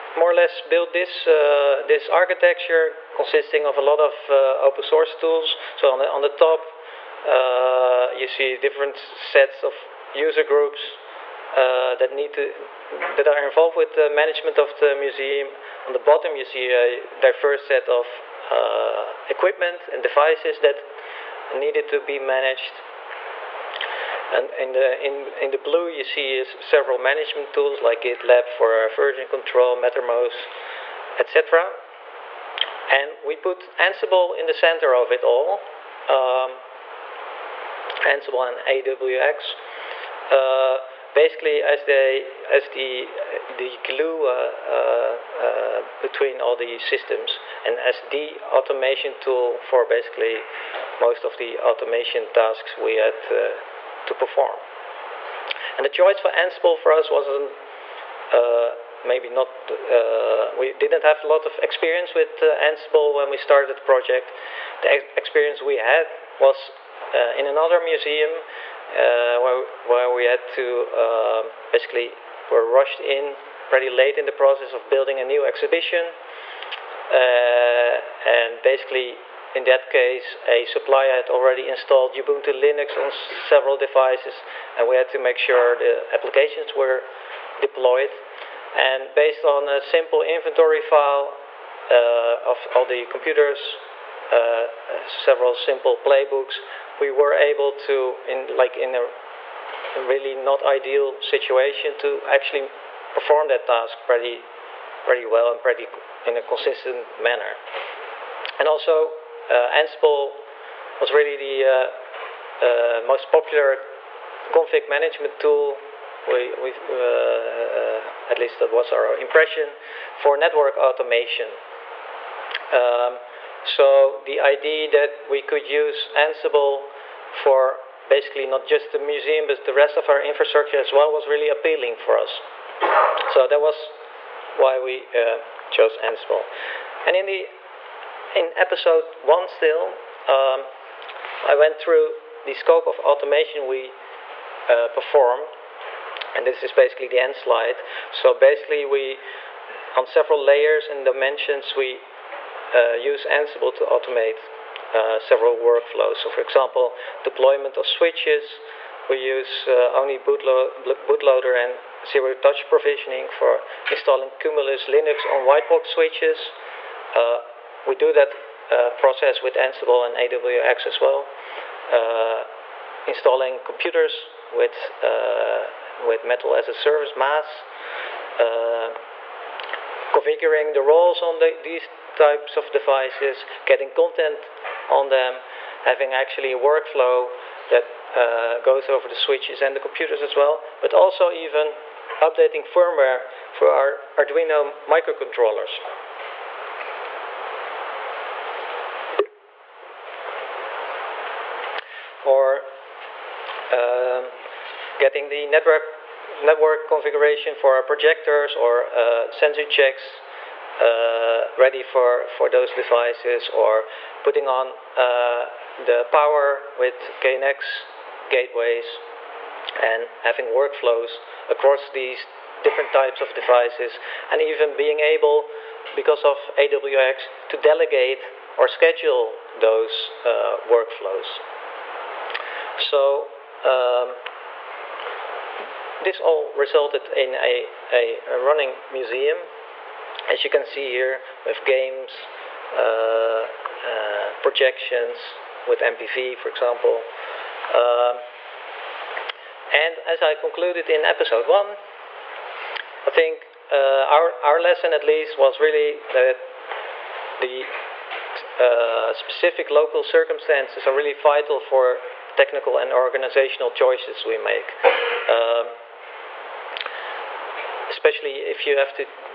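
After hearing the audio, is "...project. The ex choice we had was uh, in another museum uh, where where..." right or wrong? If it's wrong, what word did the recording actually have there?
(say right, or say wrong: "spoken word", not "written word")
wrong: "experience", not "choice".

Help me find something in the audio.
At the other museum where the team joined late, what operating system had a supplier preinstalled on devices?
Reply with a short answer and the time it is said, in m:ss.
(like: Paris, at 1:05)
Ubuntu Linux, at 1:22.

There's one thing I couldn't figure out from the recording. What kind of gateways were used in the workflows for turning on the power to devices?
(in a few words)
KNX gateways.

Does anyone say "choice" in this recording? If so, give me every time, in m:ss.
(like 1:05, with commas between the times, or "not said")
0:55, 4:23.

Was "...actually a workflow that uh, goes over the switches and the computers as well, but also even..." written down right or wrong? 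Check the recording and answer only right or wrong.
right.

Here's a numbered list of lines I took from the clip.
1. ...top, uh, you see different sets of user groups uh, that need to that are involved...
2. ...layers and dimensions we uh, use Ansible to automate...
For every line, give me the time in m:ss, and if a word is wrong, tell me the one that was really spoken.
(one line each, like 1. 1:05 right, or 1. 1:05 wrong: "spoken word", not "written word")
1. 0:06 right
2. 2:30 right.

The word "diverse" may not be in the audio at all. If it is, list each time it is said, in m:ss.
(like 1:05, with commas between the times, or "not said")
0:17.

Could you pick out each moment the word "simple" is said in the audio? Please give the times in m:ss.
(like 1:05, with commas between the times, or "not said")
1:29, 1:35.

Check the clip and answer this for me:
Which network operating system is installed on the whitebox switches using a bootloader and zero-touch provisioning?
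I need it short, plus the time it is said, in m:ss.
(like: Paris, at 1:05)
Cumulus Linux, at 2:44.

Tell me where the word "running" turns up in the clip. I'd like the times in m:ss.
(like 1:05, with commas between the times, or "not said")
3:58.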